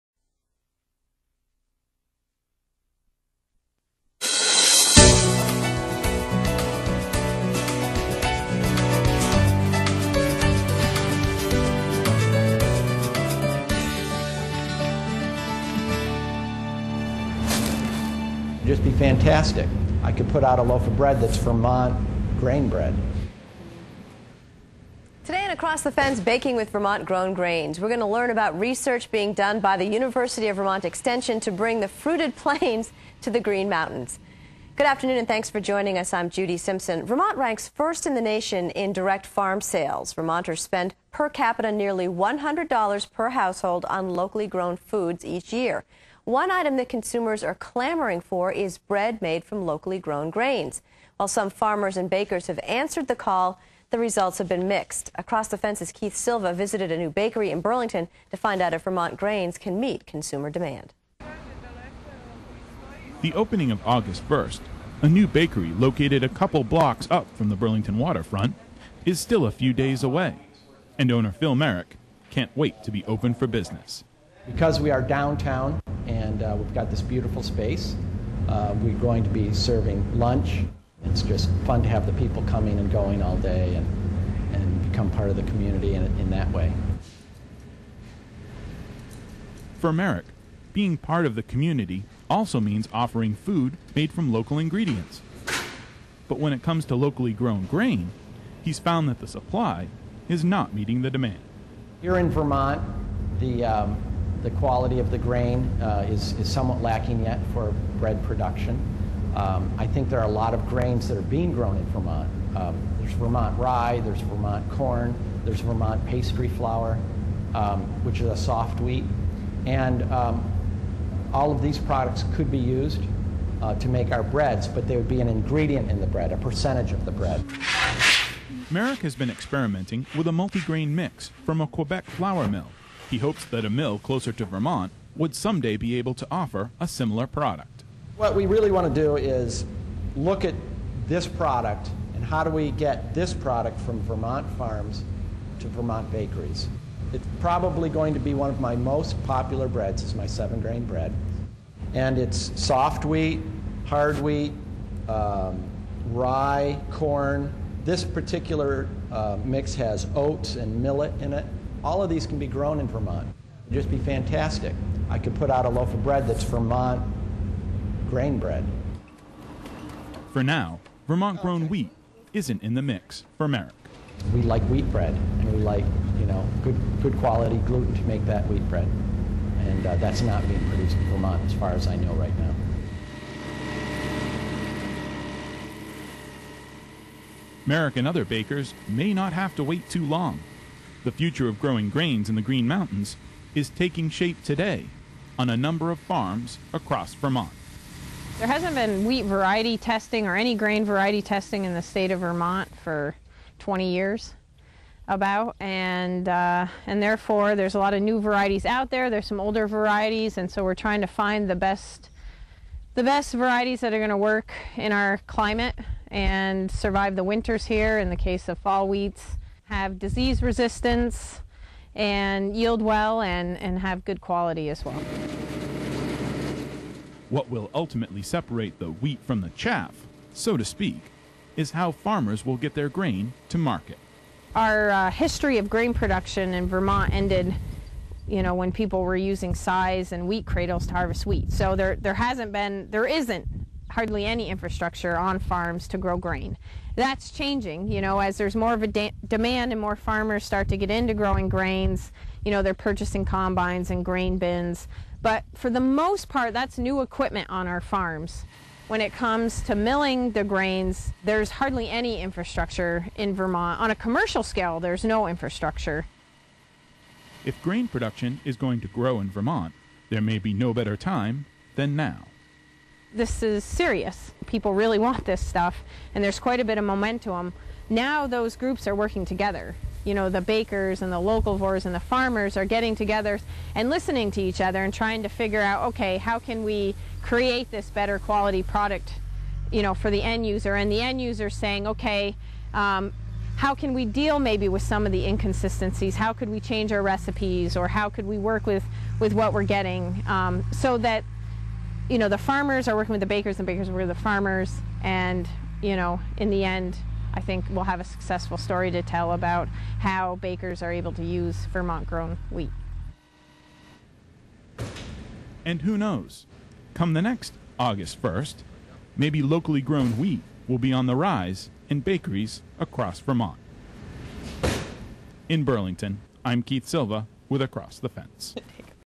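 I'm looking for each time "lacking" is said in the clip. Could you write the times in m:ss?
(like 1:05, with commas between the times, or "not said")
1:46.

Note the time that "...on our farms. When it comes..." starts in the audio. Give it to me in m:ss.
4:17.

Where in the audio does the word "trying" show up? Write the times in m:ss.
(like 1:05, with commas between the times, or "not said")
3:30, 4:44.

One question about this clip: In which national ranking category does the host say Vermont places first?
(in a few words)
Direct farm sales.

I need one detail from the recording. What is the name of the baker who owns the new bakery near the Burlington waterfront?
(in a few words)
Phil Merrick.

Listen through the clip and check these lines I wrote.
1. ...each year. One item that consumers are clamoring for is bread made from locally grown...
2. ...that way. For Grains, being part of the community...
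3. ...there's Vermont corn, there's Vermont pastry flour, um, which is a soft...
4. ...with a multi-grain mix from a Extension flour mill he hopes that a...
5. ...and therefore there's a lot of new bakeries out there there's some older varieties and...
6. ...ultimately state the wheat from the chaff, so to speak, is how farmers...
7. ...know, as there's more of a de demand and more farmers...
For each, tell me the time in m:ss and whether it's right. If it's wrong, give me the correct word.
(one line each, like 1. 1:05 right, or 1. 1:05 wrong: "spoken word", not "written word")
1. 0:45 right
2. 1:26 wrong: "Merrick", not "Grains"
3. 1:54 right
4. 2:10 wrong: "Quebec", not "Extension"
5. 3:26 wrong: "varieties", not "bakeries"
6. 3:47 wrong: "separate", not "state"
7. 4:08 right.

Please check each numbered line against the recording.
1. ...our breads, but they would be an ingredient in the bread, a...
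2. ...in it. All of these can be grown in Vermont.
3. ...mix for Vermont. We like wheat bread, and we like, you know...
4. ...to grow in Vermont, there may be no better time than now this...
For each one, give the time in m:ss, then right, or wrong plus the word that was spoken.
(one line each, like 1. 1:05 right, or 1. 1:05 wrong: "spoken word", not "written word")
1. 2:04 right
2. 2:41 right
3. 2:52 wrong: "Merrick", not "Vermont"
4. 4:28 right.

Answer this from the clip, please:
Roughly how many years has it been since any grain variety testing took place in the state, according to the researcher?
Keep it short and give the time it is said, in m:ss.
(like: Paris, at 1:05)
20 years, at 3:23.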